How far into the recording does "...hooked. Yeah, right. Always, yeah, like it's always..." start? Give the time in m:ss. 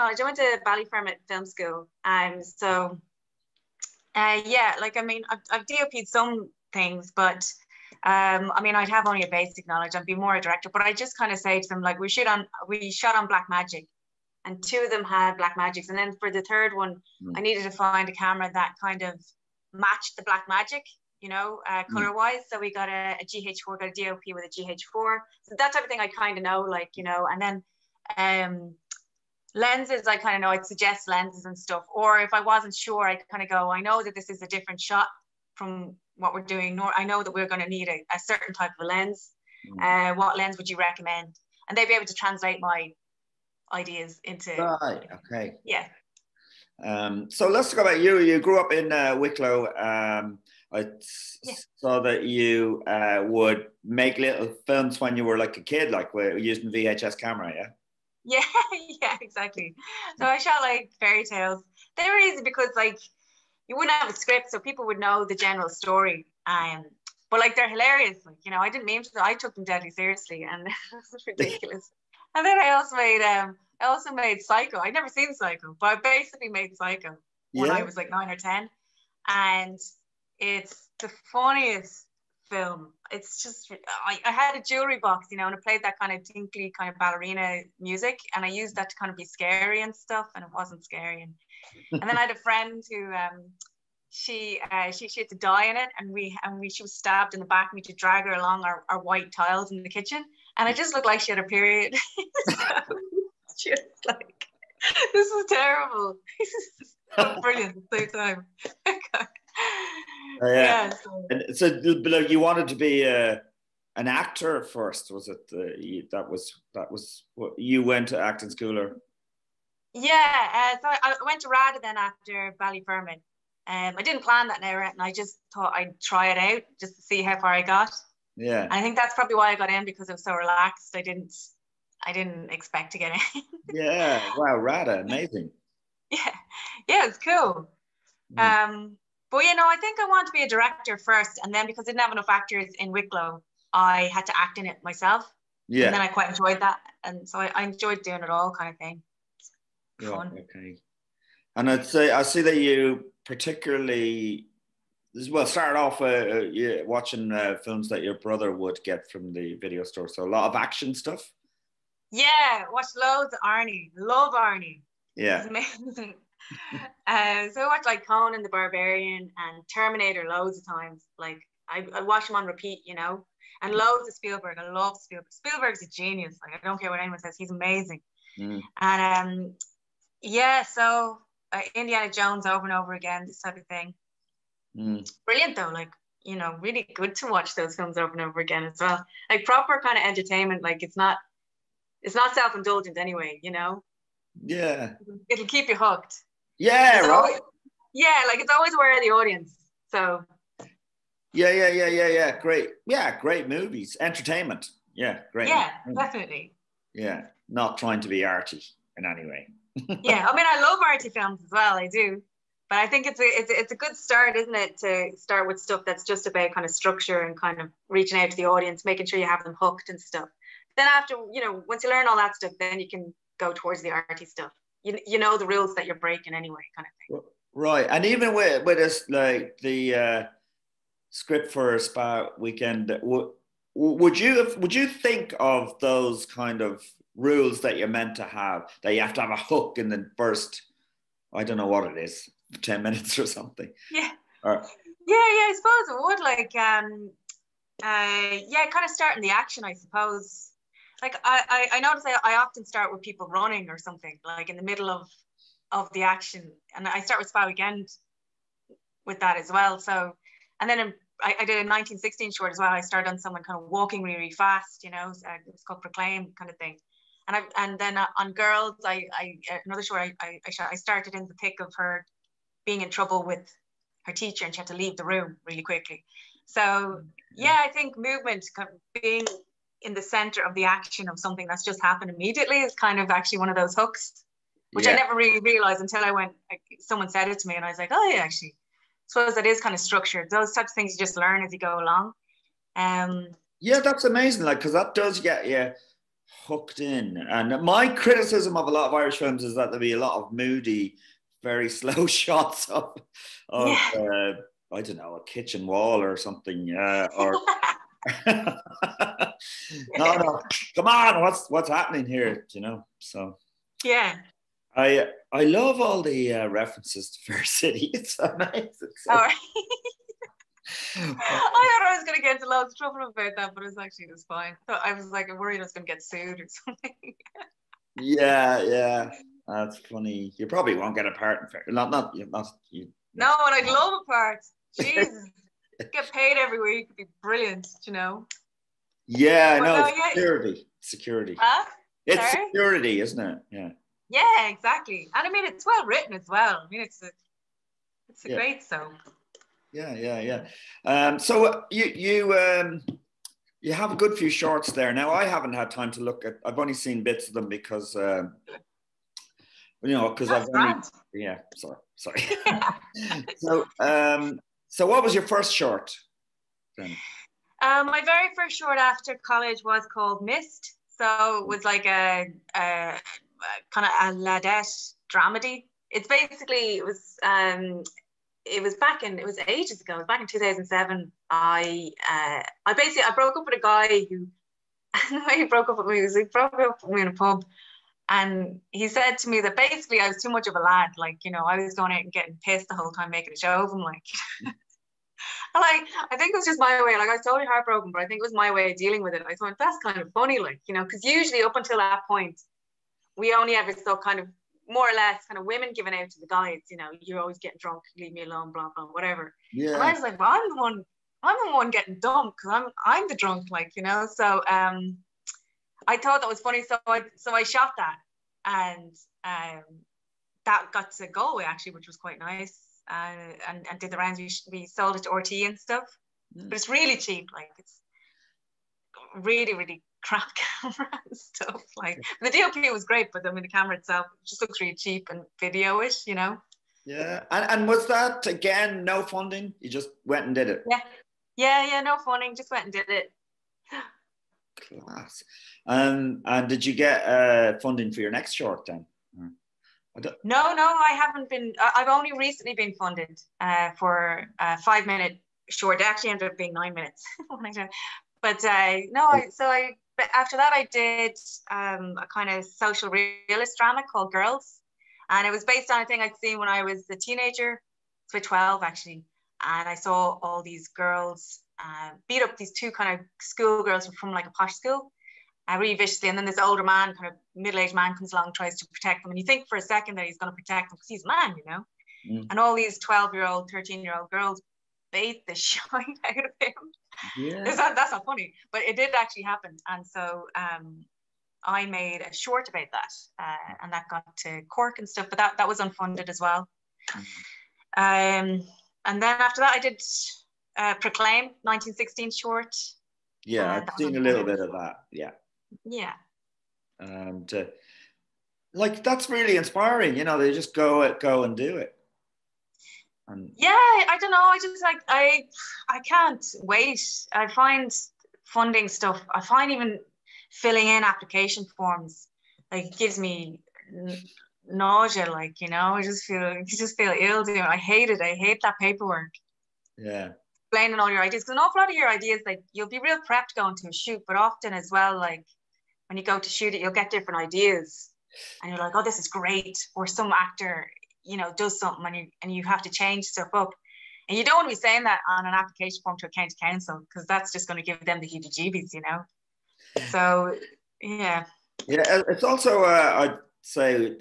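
3:15.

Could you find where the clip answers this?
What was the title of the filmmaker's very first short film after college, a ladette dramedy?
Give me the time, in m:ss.
6:10.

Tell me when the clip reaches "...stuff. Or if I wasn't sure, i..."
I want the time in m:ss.
0:31.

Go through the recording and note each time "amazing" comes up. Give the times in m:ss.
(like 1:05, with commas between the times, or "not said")
2:15, 2:57, 4:54.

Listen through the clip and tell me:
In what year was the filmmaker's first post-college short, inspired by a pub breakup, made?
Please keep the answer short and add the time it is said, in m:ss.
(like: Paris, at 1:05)
2007, at 6:20.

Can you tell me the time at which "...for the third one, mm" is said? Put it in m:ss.
0:16.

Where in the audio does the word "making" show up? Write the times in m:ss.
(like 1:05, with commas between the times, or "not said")
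3:38, 6:33.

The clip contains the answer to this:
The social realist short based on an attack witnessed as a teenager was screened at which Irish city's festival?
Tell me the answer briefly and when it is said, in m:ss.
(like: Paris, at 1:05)
Cork, at 8:14.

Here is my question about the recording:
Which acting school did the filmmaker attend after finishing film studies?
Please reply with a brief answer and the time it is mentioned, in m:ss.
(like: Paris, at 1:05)
RADA, at 2:14.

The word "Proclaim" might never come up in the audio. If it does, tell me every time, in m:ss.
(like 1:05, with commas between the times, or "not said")
4:25, 8:20.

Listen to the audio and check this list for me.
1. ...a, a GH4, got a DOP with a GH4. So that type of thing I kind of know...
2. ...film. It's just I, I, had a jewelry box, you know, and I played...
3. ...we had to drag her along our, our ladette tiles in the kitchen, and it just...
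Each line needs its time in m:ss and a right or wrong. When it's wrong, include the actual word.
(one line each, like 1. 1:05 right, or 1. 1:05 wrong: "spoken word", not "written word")
1. 0:22 right
2. 1:22 right
3. 1:37 wrong: "white", not "ladette".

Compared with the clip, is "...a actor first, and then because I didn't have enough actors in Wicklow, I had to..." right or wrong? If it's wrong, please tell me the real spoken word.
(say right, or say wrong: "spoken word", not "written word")
wrong: "director", not "actor".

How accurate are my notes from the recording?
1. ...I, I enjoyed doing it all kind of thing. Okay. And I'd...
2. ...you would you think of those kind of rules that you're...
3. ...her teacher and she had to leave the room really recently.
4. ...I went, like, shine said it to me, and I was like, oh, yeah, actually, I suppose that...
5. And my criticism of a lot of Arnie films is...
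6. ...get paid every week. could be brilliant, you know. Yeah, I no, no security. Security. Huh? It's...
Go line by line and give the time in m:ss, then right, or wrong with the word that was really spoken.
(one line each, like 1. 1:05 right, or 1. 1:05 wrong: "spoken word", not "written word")
1. 2:27 right
2. 3:54 right
3. 4:34 wrong: "quickly", not "recently"
4. 4:46 wrong: "someone", not "shine"
5. 4:57 wrong: "Irish", not "Arnie"
6. 5:35 right.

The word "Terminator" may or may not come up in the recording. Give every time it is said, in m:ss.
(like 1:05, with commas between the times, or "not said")
2:49.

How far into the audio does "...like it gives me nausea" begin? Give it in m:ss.
8:42.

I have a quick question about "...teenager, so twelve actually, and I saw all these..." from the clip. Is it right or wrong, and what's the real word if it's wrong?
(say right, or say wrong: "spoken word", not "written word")
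right.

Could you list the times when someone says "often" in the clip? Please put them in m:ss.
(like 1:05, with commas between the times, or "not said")
4:12, 8:54.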